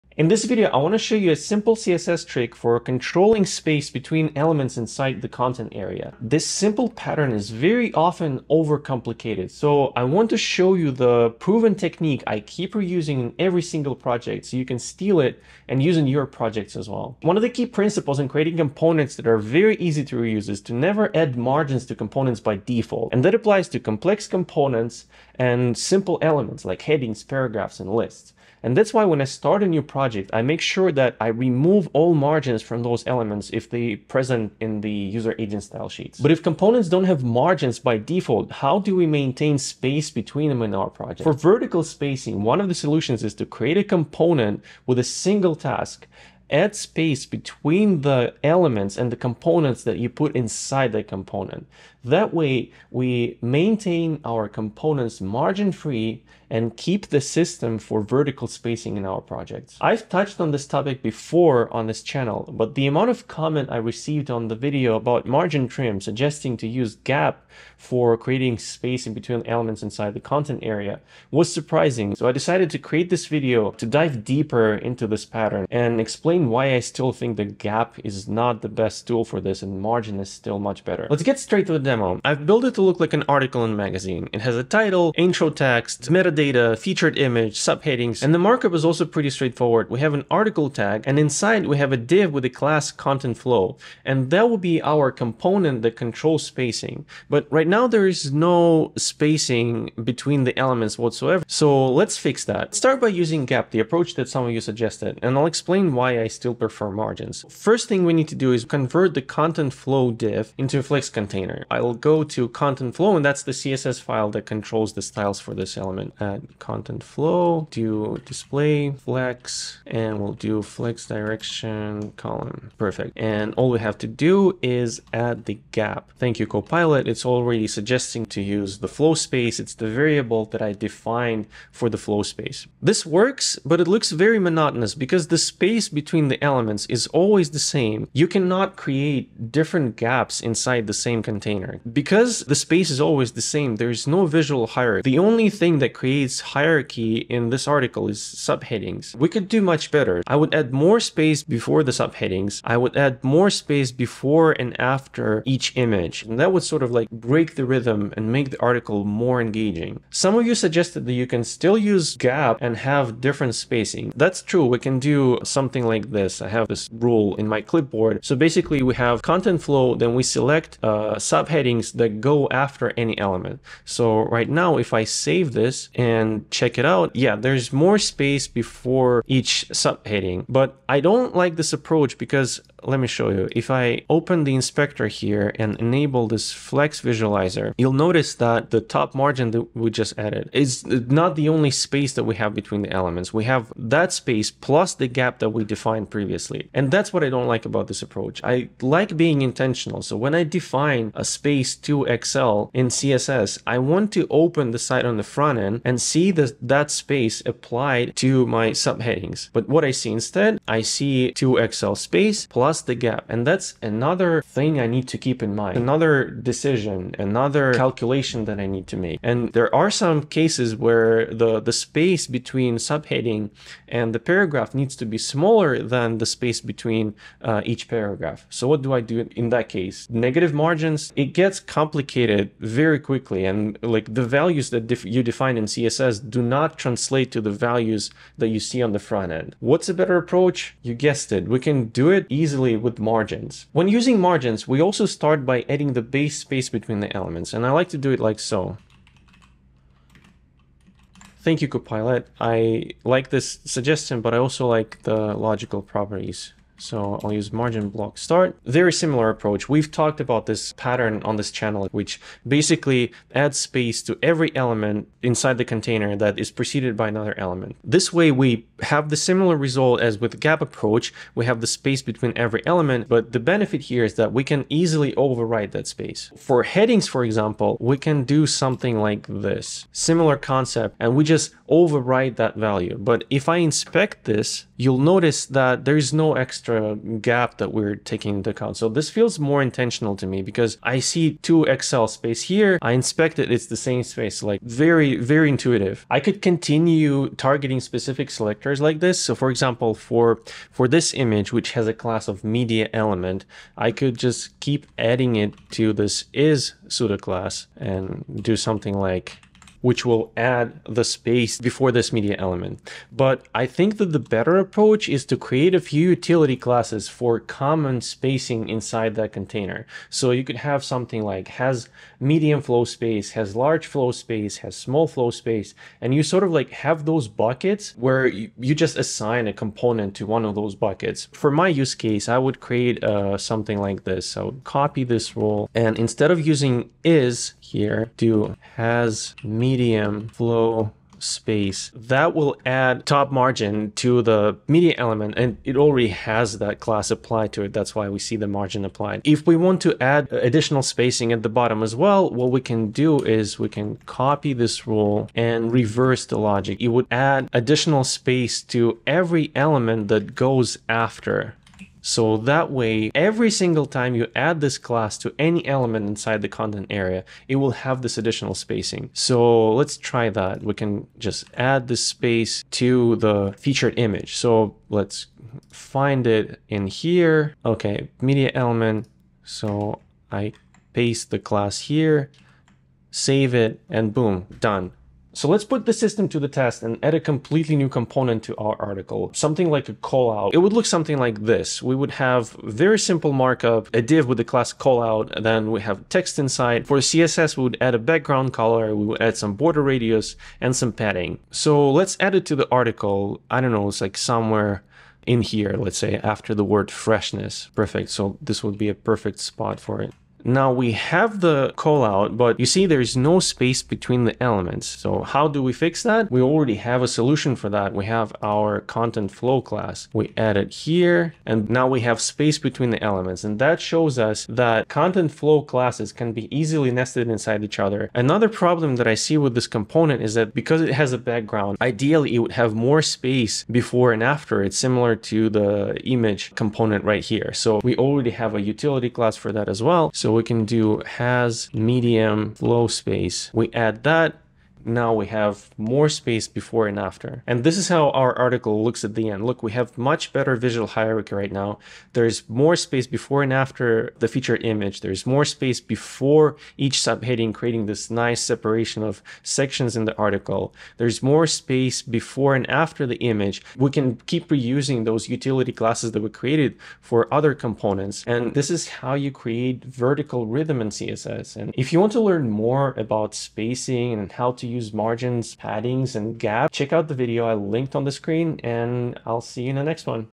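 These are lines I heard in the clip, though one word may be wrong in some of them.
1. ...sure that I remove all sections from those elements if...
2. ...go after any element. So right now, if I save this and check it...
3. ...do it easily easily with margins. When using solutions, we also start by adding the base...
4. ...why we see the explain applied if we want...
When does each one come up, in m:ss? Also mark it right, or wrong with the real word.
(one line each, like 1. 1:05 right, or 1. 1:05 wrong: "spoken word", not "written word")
1. 0:30 wrong: "margins", not "sections"
2. 2:52 right
3. 4:01 wrong: "margins", not "solutions"
4. 5:47 wrong: "margin", not "explain".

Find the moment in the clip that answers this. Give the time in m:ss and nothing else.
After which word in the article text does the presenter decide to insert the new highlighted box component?
6:46.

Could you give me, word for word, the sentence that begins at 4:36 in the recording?
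For headings, for example, we can do something like this, similar concept, and we just override that value.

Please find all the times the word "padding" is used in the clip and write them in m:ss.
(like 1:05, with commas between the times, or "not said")
6:40, 7:55.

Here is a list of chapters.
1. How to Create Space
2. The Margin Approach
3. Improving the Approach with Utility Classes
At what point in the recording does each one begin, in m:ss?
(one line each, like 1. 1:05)
1. 0:42
2. 4:00
3. 4:58.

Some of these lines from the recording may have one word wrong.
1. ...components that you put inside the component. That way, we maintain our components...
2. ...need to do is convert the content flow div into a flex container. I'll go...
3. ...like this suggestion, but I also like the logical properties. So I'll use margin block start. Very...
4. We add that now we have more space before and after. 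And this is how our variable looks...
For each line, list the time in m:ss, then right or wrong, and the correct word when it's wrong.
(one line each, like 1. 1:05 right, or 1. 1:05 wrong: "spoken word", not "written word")
1. 0:49 right
2. 1:48 right
3. 4:13 right
4. 7:23 wrong: "article", not "variable".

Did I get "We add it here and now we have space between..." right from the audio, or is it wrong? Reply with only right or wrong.
right.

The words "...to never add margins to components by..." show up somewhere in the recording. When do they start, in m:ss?
0:20.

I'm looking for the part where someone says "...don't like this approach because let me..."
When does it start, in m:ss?
3:00.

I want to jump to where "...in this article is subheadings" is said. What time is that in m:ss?
2:27.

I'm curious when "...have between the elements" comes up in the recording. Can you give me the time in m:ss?
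3:12.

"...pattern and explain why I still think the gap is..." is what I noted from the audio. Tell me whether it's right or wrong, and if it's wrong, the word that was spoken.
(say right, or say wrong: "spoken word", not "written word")
right.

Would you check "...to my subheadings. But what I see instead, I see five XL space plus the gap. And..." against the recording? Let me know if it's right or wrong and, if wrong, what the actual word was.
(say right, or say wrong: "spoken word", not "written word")
wrong: "two", not "five".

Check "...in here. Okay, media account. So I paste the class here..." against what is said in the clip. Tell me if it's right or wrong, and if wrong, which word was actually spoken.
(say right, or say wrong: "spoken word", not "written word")
wrong: "element", not "account".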